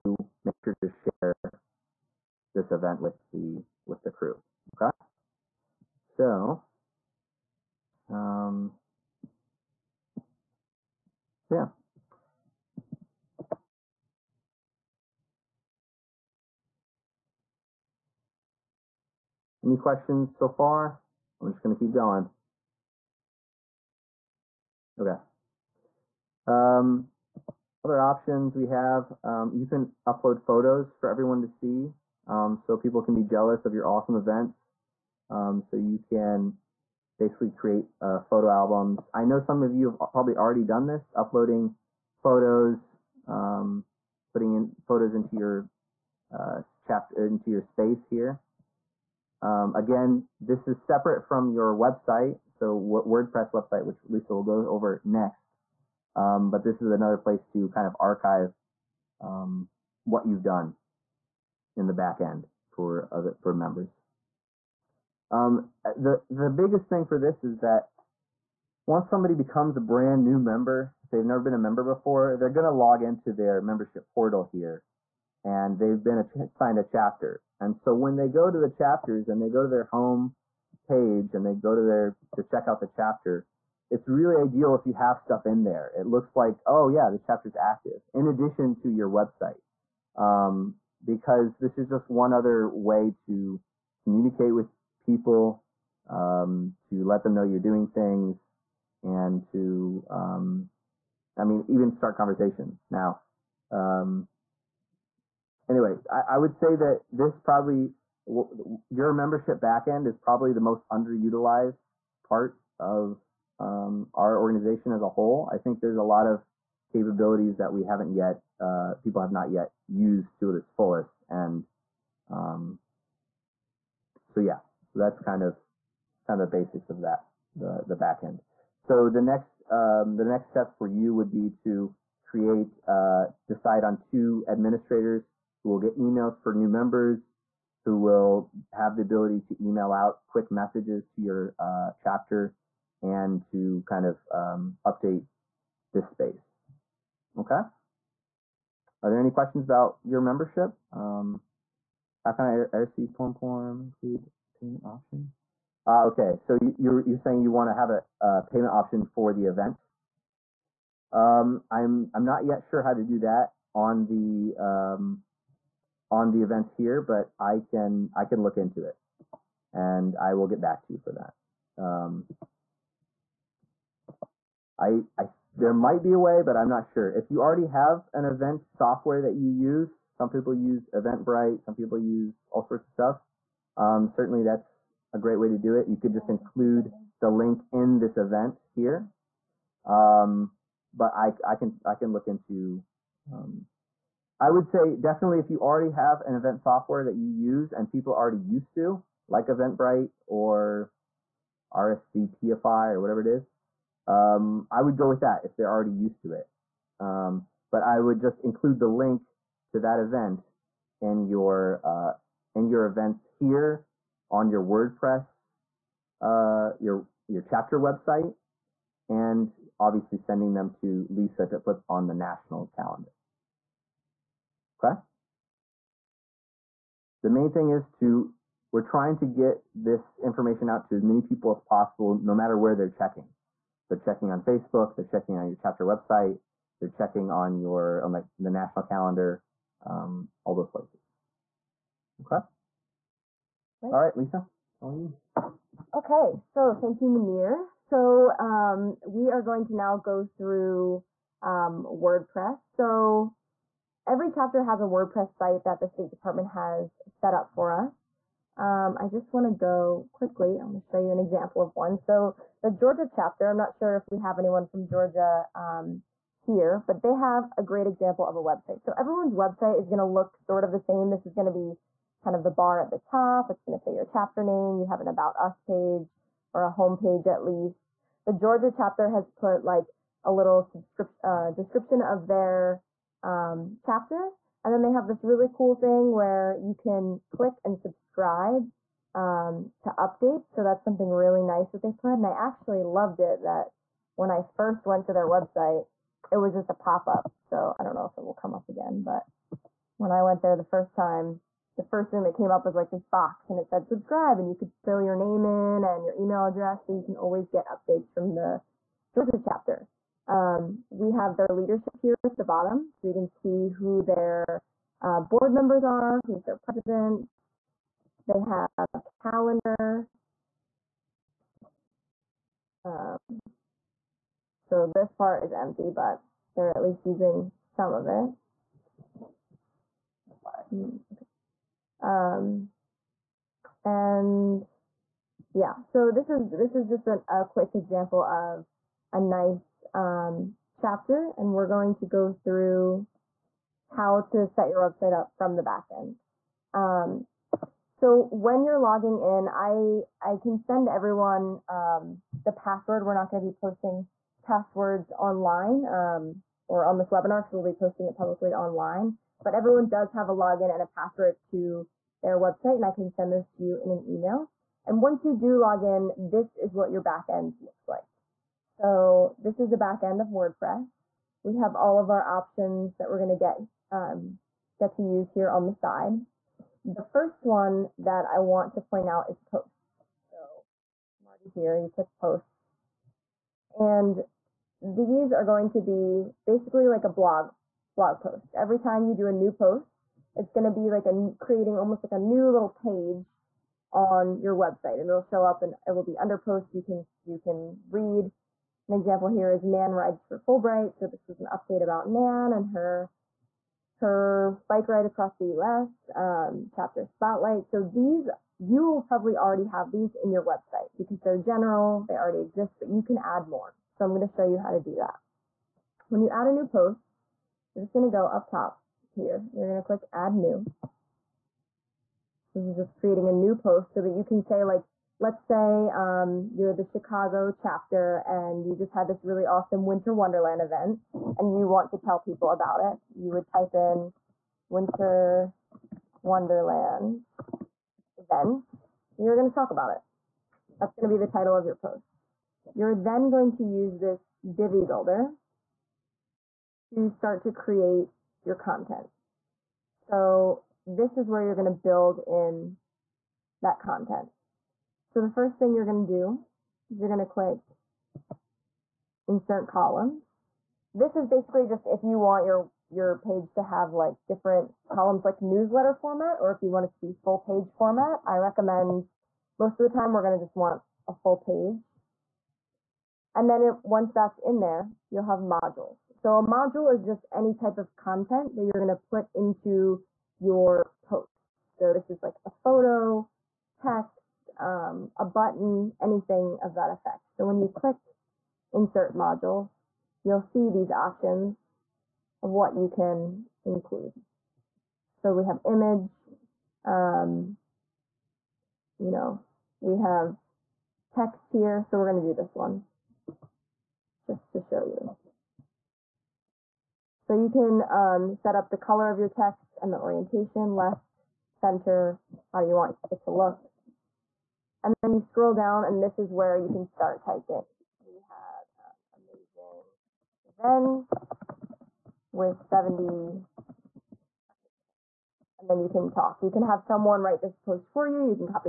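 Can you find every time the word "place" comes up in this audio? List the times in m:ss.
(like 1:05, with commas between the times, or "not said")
0:57, 4:00.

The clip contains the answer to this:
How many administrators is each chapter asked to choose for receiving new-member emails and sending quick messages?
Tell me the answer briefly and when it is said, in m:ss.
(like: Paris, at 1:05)
2, at 2:13.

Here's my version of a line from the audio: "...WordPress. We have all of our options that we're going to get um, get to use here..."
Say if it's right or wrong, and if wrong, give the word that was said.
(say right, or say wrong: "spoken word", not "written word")
right.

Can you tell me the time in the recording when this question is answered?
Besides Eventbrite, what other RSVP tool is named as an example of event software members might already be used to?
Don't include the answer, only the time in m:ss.
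3:21.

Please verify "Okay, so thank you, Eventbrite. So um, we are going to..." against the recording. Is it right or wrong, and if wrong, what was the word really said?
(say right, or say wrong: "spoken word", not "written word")
wrong: "Munir", not "Eventbrite".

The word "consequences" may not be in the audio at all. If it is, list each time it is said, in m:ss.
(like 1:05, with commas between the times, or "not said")
not said.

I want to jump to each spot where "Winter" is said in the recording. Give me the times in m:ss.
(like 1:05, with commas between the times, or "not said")
7:09, 7:14.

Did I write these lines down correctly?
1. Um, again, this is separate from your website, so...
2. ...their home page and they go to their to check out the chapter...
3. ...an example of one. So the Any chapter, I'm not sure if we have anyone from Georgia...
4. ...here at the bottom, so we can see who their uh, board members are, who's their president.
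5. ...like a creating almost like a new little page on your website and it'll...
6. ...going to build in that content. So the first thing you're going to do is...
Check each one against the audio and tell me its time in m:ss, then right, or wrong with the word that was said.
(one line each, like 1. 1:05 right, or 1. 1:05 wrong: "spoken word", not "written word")
1. 0:49 right
2. 1:19 right
3. 4:21 wrong: "Georgia", not "Any"
4. 5:11 right
5. 6:30 right
6. 7:31 right.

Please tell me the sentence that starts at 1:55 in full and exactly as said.
I think there's a lot of capabilities that we haven't yet, uh, people have not yet used to its fullest.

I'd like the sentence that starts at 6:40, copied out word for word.
So this was an update about Nan and her her bike ride across the U.S.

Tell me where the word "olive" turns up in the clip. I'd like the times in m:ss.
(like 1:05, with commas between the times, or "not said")
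not said.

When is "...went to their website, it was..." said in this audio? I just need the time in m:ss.
4:54.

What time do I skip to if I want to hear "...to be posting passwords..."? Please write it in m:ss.
5:53.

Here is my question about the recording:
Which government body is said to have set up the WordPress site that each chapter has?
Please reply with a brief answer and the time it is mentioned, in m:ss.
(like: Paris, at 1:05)
State Department, at 4:15.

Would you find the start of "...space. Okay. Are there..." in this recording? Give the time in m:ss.
2:26.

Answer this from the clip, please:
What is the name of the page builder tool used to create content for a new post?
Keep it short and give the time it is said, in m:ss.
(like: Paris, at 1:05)
Divi builder, at 7:24.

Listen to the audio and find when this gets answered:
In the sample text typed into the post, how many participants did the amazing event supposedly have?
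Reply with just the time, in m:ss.
8:42.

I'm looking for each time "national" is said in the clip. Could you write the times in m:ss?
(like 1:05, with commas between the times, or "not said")
3:42, 3:58.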